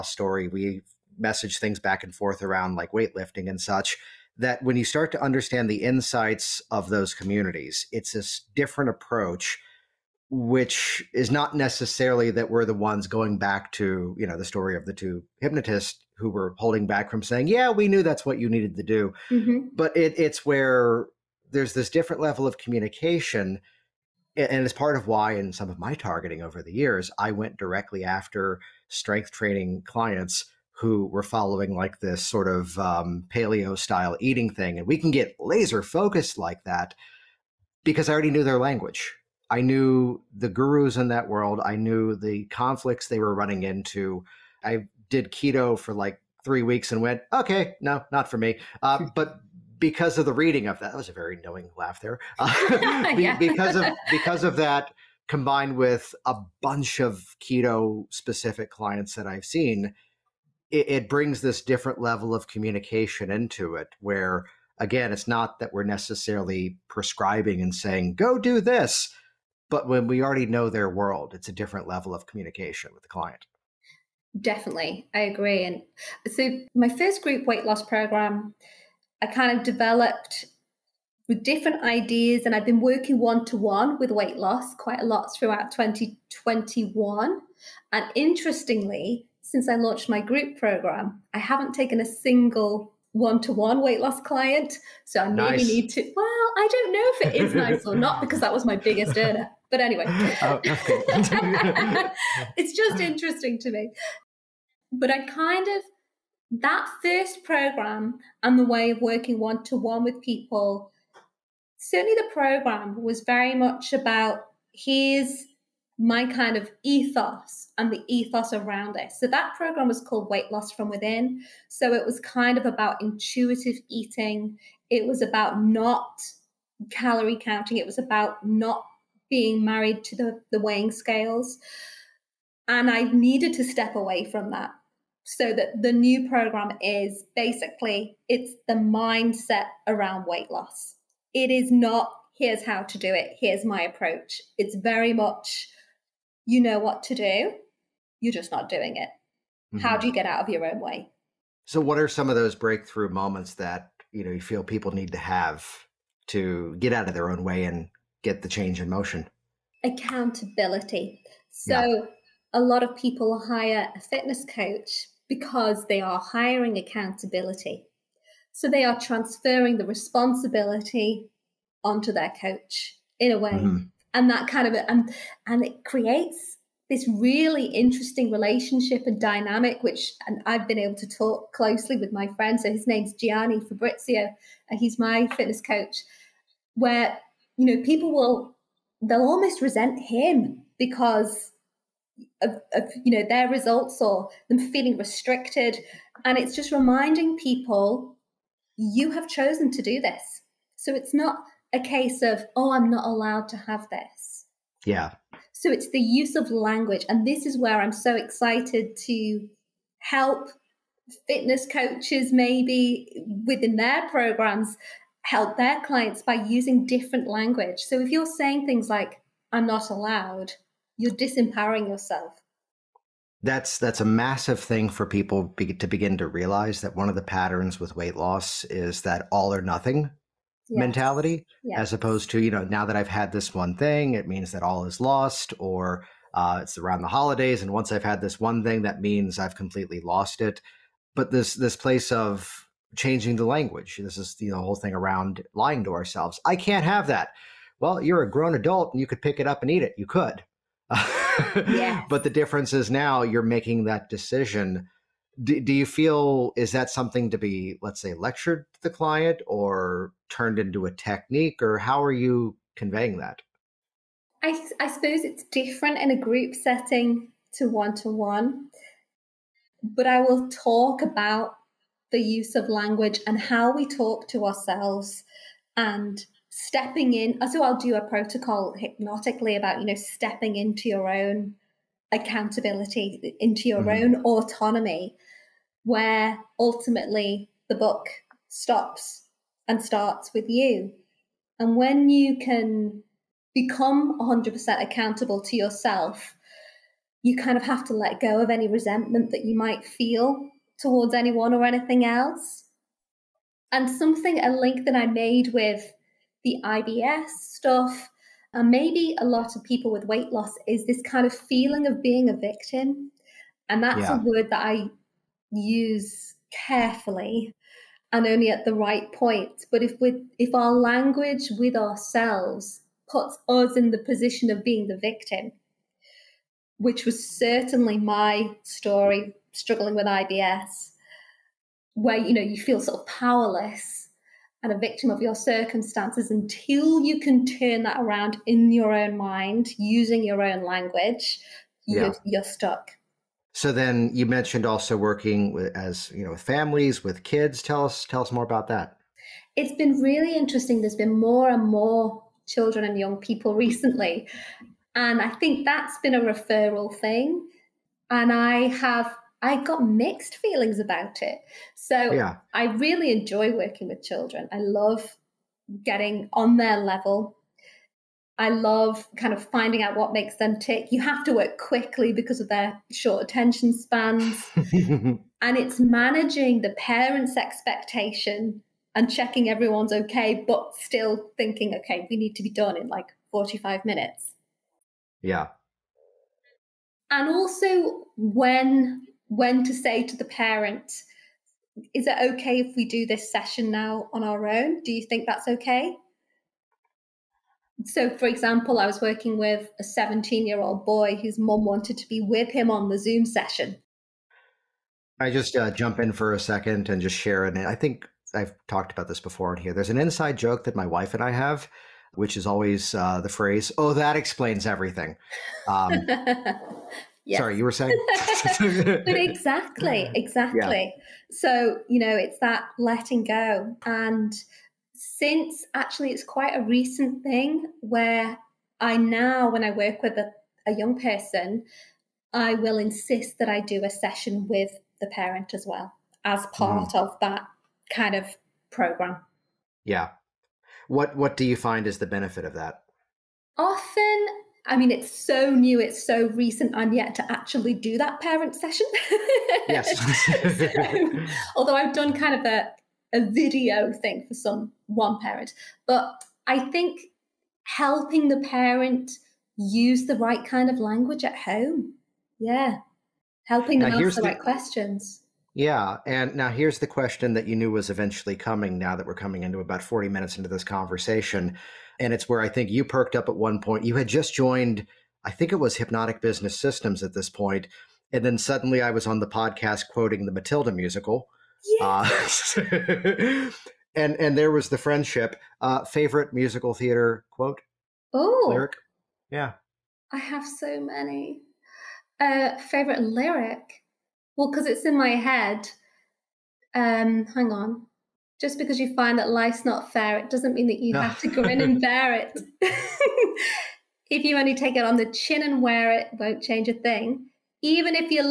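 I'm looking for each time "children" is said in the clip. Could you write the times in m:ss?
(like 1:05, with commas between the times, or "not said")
5:52, 6:04.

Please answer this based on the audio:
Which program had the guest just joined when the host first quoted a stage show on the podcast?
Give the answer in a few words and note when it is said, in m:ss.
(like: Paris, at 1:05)
Hypnotic Business Systems, at 7:55.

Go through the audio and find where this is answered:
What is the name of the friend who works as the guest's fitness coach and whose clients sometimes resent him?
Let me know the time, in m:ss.
3:03.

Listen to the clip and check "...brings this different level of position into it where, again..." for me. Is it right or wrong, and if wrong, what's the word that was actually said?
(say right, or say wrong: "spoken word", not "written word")
wrong: "communication", not "position".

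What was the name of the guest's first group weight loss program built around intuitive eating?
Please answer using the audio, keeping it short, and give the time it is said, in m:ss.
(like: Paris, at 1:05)
Weight Loss from Within, at 2:00.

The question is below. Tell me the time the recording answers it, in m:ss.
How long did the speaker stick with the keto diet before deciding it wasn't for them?
0:46.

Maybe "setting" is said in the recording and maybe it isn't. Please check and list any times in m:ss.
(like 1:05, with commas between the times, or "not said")
4:26.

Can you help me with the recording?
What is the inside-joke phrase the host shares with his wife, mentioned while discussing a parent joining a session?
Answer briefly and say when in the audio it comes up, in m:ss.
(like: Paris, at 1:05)
that explains everything, at 6:53.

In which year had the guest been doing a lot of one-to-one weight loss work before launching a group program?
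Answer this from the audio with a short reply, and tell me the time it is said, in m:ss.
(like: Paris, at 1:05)
2021, at 1:25.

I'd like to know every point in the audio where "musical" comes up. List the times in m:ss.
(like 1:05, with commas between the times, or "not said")
8:00, 8:06.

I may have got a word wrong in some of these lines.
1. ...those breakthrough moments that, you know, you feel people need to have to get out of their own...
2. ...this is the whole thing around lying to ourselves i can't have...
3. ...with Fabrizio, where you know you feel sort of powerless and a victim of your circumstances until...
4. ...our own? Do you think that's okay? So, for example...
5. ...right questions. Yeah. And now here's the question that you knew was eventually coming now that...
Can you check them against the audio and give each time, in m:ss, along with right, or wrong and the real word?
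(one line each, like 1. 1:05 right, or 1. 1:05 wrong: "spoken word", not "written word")
1. 2:32 right
2. 4:04 right
3. 5:29 wrong: "IBS", not "Fabrizio"
4. 6:34 right
5. 7:44 right.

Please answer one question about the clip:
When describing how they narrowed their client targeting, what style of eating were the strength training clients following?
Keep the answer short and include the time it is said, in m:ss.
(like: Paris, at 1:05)
paleo, at 0:33.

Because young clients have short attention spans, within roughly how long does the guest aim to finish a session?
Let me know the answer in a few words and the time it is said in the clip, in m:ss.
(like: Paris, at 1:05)
45 minutes, at 6:23.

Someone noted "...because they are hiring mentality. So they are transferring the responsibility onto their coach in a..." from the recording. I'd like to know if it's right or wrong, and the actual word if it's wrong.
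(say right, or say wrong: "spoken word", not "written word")
wrong: "accountability", not "mentality".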